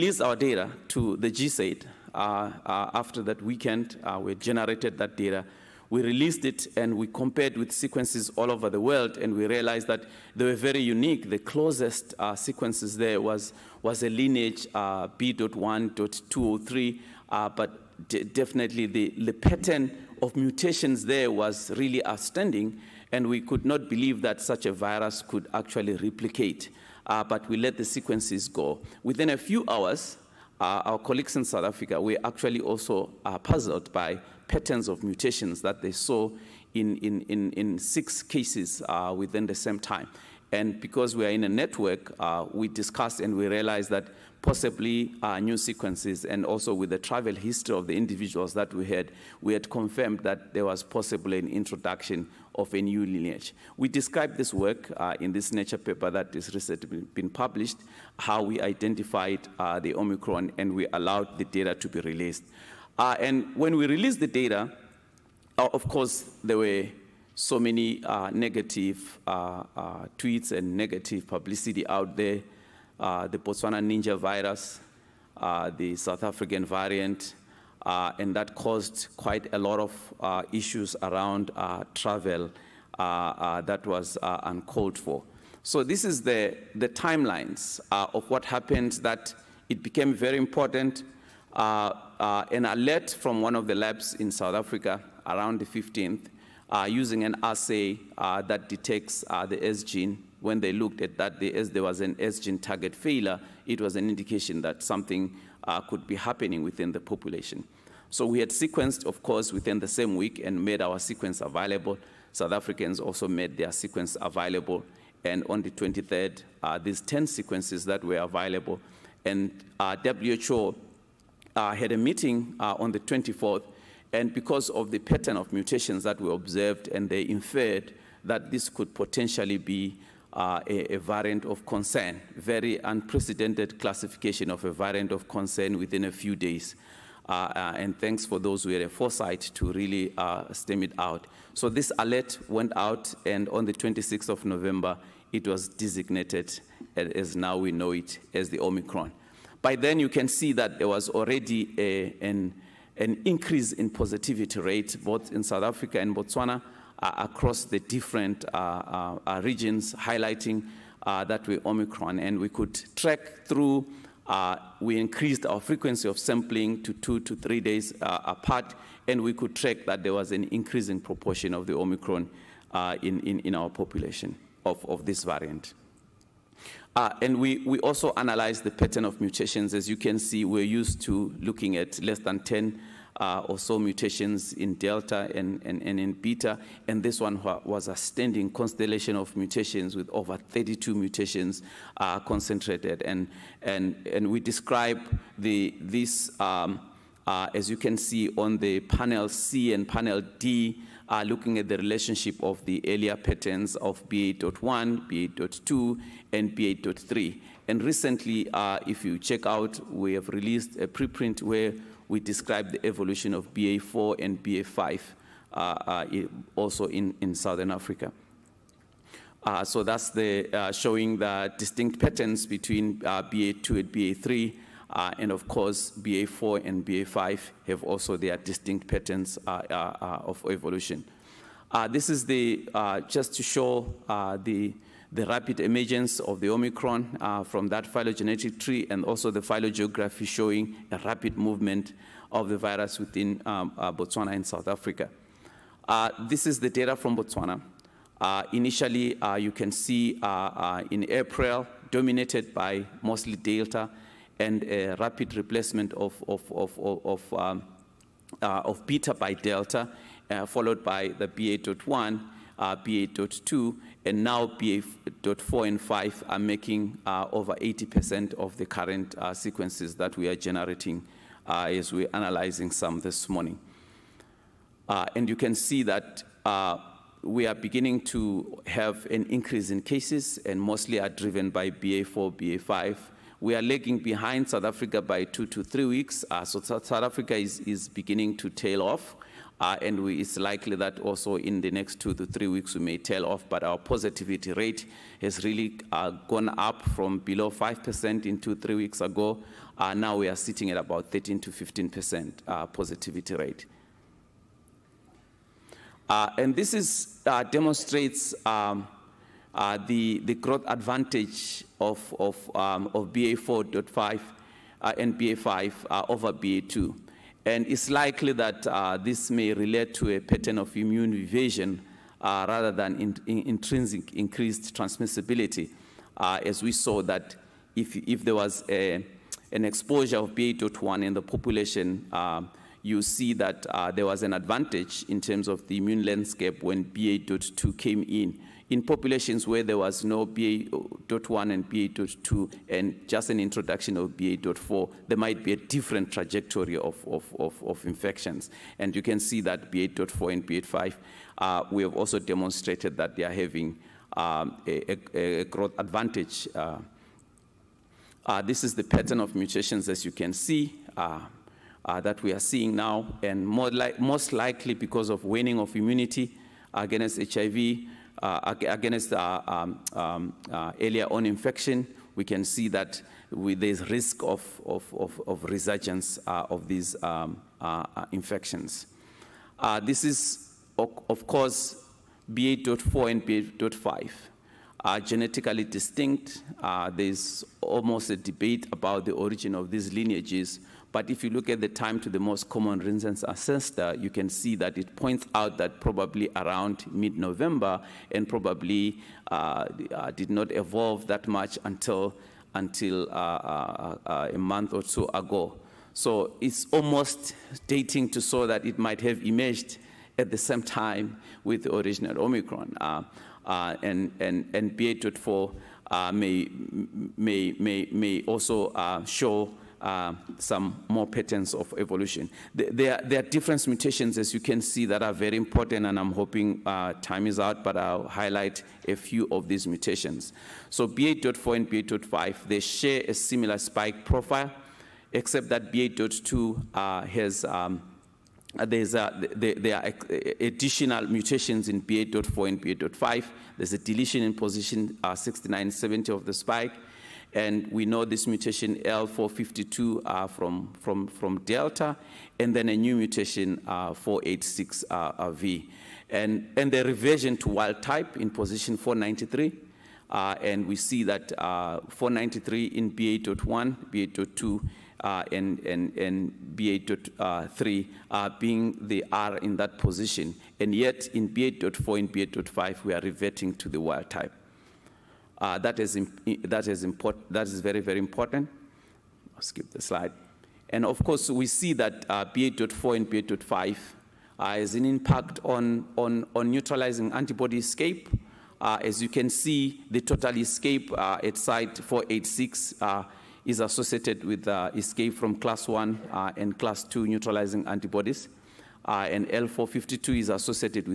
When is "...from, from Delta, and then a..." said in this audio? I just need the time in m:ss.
7:30.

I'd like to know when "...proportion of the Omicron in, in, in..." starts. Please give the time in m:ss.
2:50.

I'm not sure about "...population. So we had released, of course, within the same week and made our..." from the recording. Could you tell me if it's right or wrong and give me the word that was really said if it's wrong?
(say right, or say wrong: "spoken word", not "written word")
wrong: "sequenced", not "released".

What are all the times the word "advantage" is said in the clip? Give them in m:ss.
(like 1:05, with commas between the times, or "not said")
5:10, 5:34, 5:55.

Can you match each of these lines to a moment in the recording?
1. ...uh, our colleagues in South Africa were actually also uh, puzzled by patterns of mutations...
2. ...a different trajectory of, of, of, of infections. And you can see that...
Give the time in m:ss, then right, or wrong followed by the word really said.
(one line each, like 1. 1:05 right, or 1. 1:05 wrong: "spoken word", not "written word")
1. 0:30 right
2. 5:45 right.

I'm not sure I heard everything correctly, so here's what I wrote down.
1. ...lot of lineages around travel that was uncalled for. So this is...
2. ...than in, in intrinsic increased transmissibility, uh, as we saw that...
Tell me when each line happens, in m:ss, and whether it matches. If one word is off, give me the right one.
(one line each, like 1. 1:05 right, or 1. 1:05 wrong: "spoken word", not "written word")
1. 1:19 wrong: "issues", not "lineages"
2. 5:22 right.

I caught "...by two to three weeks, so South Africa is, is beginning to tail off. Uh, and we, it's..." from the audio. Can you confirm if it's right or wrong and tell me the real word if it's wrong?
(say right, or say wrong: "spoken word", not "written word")
right.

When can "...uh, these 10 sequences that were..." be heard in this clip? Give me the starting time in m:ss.
1:56.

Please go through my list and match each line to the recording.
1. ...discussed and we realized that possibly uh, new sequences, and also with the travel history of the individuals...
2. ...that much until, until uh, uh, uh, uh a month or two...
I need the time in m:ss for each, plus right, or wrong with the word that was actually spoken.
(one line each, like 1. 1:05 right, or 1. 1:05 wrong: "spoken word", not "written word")
1. 0:42 right
2. 6:41 right.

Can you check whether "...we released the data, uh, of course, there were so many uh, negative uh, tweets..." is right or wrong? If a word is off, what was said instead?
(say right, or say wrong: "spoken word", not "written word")
right.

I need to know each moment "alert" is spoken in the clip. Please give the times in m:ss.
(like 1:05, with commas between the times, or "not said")
1:32, 2:21.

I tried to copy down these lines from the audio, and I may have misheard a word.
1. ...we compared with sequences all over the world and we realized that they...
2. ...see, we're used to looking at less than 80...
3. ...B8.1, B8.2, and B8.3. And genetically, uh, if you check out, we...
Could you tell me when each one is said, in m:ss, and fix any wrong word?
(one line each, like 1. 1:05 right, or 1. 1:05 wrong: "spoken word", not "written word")
1. 0:06 right
2. 3:00 wrong: "10", not "80"
3. 3:24 wrong: "recently", not "genetically".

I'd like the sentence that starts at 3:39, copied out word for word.
Uh, so that's the, uh, showing the distinct patterns between uh, BA2 and BA3.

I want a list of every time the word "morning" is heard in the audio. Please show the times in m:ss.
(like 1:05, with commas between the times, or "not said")
4:33.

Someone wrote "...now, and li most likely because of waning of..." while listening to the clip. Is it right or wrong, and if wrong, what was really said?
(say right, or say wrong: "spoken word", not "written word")
right.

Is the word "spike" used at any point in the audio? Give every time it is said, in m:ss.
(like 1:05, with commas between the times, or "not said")
7:13, 7:26.